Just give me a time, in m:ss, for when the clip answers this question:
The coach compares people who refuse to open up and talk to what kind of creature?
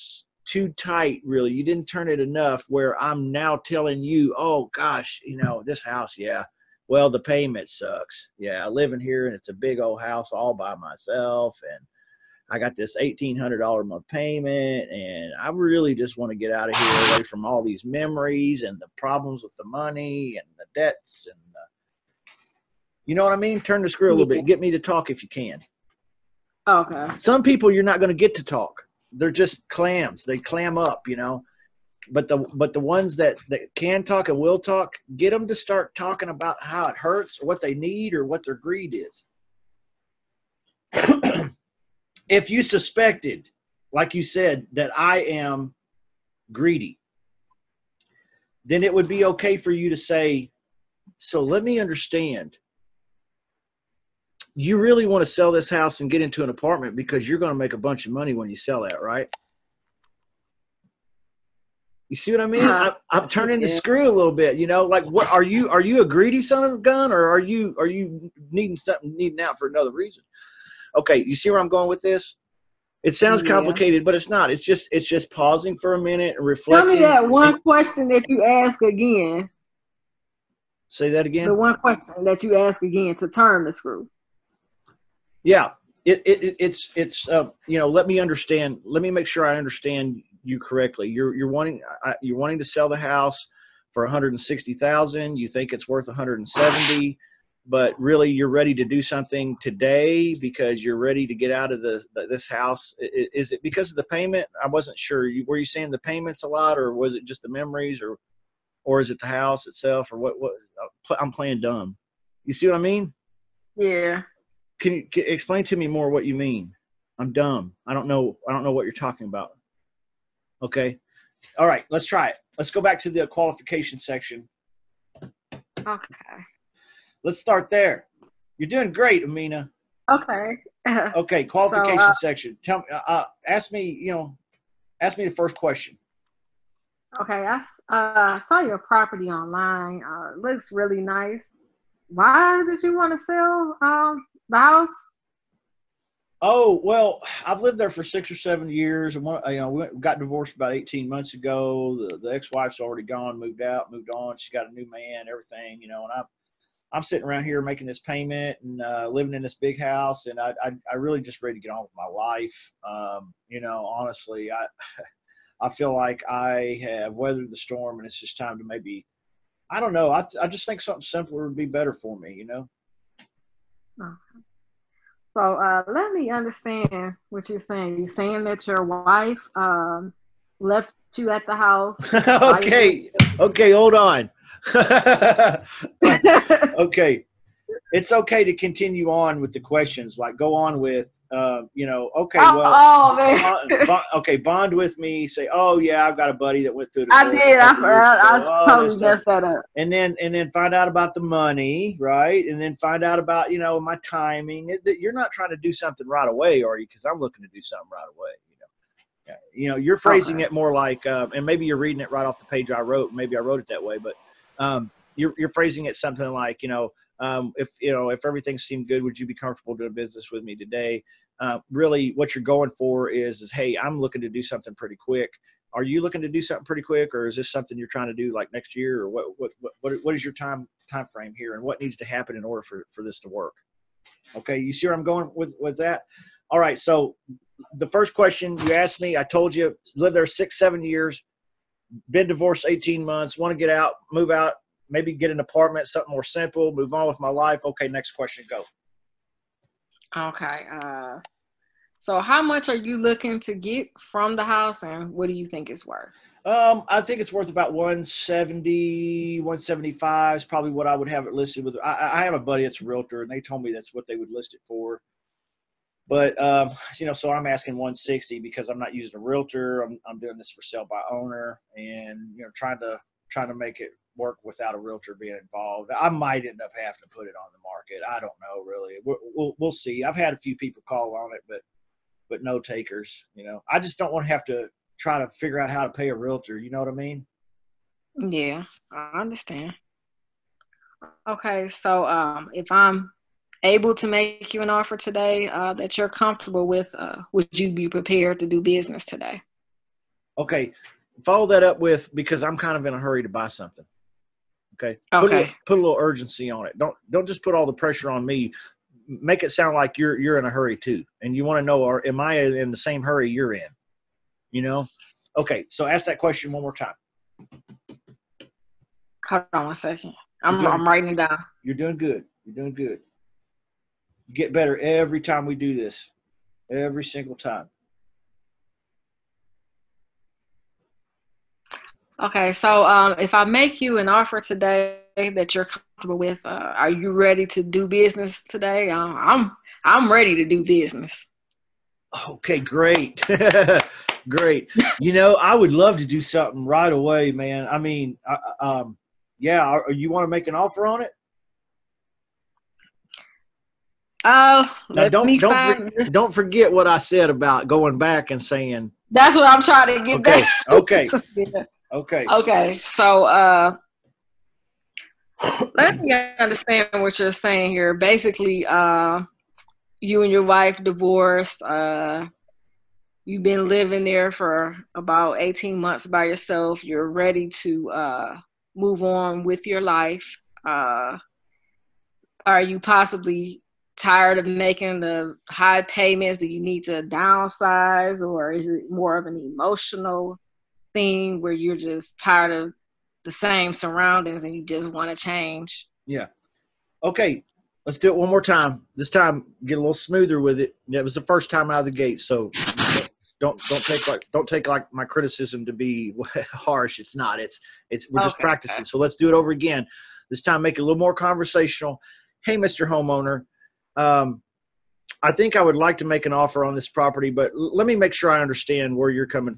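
0:29.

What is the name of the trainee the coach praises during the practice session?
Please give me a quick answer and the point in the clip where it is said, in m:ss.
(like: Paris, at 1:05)
Amina, at 2:09.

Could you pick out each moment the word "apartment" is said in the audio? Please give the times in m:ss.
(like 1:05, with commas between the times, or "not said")
0:56, 4:05.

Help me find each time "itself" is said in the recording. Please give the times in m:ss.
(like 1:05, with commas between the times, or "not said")
1:49.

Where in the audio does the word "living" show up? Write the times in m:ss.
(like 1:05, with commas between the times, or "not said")
2:39, 6:13.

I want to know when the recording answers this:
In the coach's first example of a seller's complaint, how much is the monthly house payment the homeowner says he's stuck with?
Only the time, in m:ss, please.
0:12.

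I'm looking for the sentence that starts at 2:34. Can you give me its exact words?
She's got a new man, everything, you know.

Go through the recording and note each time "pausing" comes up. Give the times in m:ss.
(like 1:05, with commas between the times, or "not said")
1:15.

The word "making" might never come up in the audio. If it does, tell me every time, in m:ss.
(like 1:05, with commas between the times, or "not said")
2:37, 6:24.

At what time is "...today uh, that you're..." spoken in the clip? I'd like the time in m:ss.
4:54.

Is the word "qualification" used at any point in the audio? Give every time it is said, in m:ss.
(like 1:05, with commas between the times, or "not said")
2:03, 2:11.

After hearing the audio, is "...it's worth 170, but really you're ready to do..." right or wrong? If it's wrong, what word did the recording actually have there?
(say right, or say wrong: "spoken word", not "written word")
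right.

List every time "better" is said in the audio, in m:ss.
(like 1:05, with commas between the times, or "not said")
2:51, 5:24.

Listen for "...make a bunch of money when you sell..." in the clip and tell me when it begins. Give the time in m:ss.
0:57.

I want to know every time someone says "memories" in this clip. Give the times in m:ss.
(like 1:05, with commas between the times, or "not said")
0:17, 1:47.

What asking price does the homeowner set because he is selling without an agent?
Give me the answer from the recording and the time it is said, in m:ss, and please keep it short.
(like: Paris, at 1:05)
160, at 4:27.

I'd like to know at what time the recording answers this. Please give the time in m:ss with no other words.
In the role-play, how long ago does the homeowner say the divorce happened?
2:30.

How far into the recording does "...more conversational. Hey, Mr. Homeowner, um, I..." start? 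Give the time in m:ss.
6:50.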